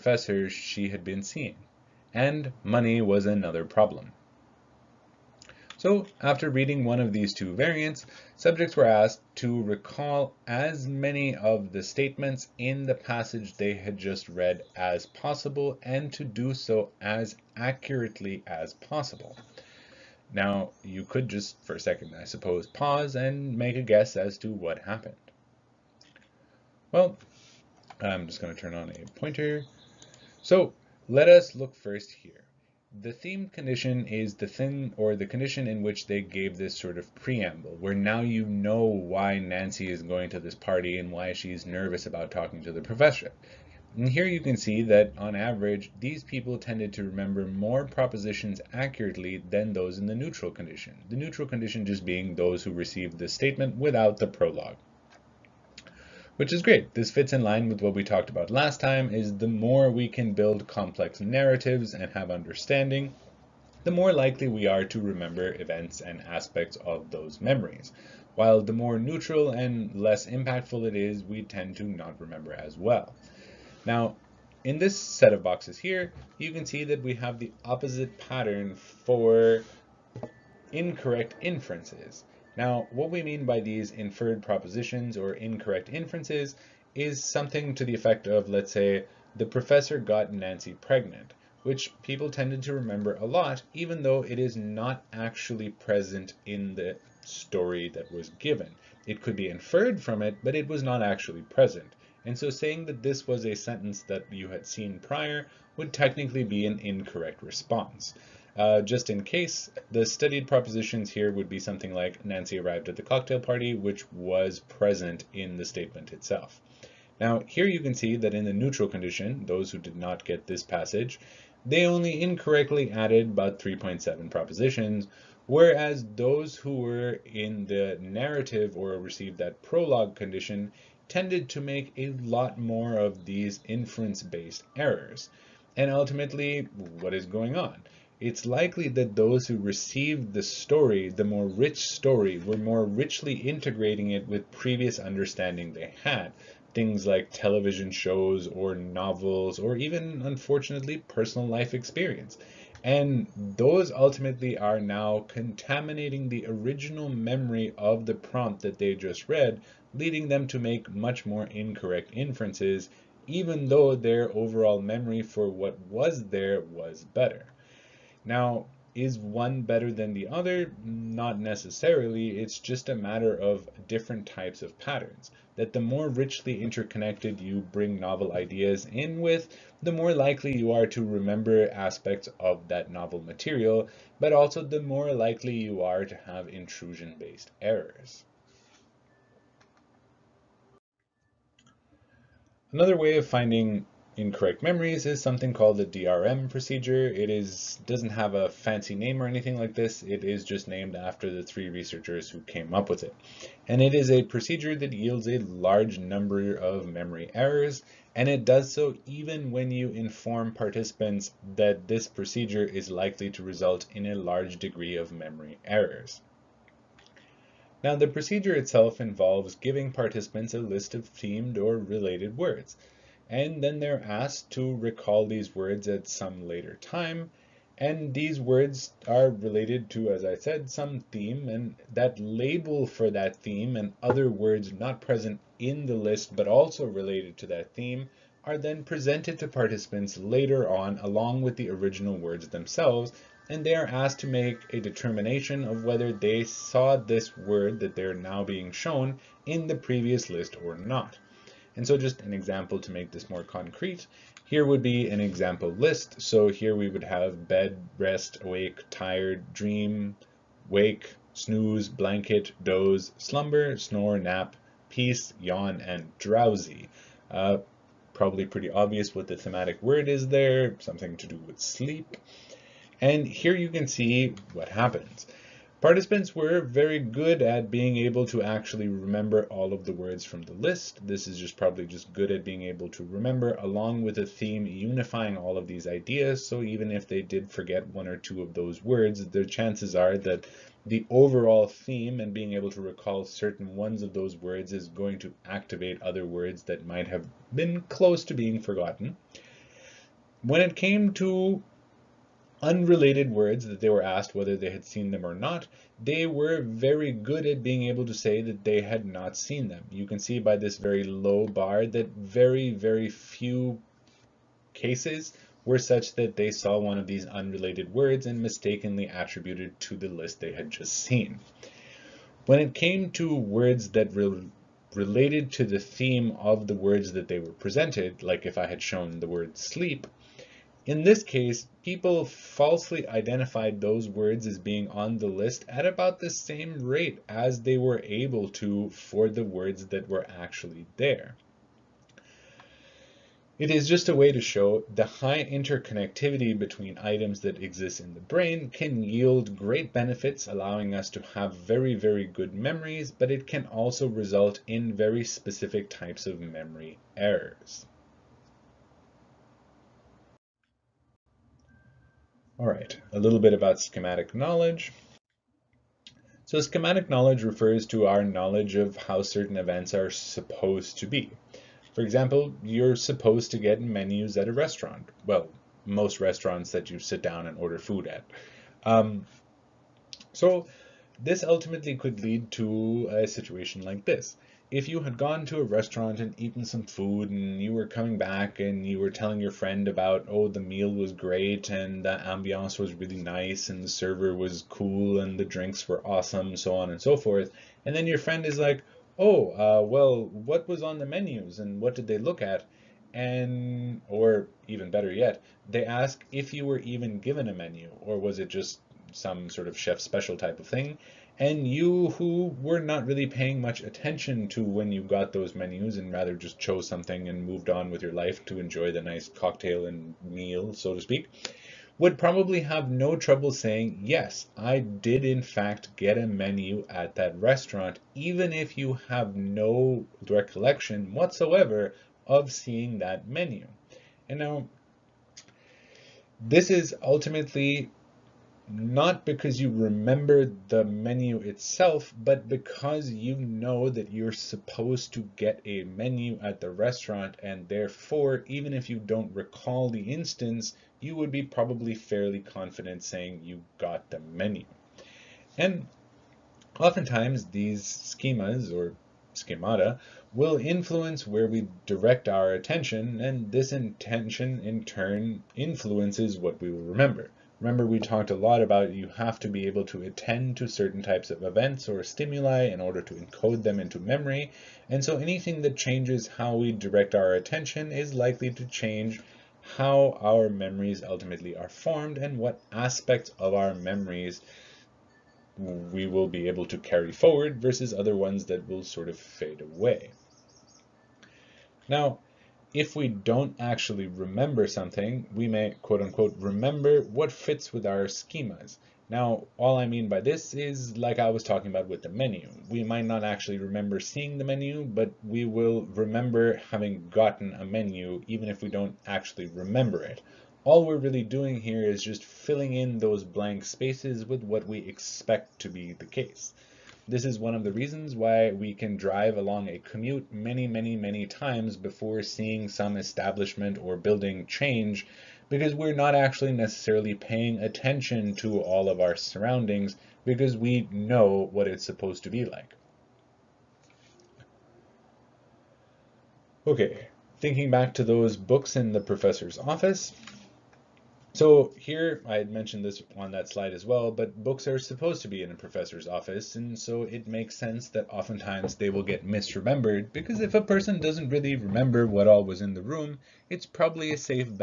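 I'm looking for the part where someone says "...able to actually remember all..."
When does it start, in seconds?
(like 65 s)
277 s.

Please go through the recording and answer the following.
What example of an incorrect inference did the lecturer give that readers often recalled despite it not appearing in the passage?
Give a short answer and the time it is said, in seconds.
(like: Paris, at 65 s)
The professor got Nancy pregnant, at 89 s.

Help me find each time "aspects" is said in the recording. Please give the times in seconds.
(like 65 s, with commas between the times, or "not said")
66 s, 181 s, 482 s.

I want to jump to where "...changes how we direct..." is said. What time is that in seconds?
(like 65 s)
475 s.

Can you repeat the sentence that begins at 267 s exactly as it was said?
Uh, probably pretty obvious what the thematic word is there, something to do with sleep.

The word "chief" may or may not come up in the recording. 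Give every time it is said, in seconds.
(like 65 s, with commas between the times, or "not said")
not said.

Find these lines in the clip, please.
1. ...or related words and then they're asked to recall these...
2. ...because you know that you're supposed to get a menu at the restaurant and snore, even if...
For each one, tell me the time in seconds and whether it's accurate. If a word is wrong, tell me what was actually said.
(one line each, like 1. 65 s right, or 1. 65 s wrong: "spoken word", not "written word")
1. 221 s right
2. 442 s wrong: "therefore", not "snore".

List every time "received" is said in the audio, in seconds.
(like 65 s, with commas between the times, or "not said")
52 s, 128 s, 139 s.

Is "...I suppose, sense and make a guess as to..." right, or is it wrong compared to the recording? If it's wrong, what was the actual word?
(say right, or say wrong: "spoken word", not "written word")
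wrong: "pause", not "sense".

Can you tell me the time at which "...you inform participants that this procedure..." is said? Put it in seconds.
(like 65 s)
209 s.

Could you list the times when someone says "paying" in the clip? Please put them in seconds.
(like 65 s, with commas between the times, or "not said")
413 s, 527 s.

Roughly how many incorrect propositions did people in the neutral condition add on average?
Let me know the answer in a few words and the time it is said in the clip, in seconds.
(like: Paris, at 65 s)
3.7, at 123 s.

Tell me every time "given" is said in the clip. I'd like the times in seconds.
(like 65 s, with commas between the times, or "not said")
98 s, 407 s.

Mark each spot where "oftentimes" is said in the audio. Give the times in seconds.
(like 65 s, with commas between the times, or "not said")
456 s, 548 s.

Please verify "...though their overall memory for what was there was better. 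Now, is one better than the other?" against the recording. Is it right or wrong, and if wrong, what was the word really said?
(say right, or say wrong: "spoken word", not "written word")
right.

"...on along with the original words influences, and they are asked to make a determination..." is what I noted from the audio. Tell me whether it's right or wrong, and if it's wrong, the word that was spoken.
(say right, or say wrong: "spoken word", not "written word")
wrong: "themselves", not "influences".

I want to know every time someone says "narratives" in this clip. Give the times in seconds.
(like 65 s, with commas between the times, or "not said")
61 s, 127 s.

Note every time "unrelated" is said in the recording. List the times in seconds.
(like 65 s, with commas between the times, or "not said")
302 s, 317 s.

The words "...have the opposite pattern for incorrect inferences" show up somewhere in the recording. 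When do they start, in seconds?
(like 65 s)
77 s.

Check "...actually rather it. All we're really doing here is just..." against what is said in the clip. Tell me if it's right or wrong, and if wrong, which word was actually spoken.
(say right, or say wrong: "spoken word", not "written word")
wrong: "remember", not "rather".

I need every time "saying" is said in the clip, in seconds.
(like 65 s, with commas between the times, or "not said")
102 s, 423 s, 453 s.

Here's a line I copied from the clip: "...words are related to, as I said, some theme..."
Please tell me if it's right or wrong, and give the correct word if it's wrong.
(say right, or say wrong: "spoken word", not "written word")
right.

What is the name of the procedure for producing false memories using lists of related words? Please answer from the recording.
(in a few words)
DRM procedure.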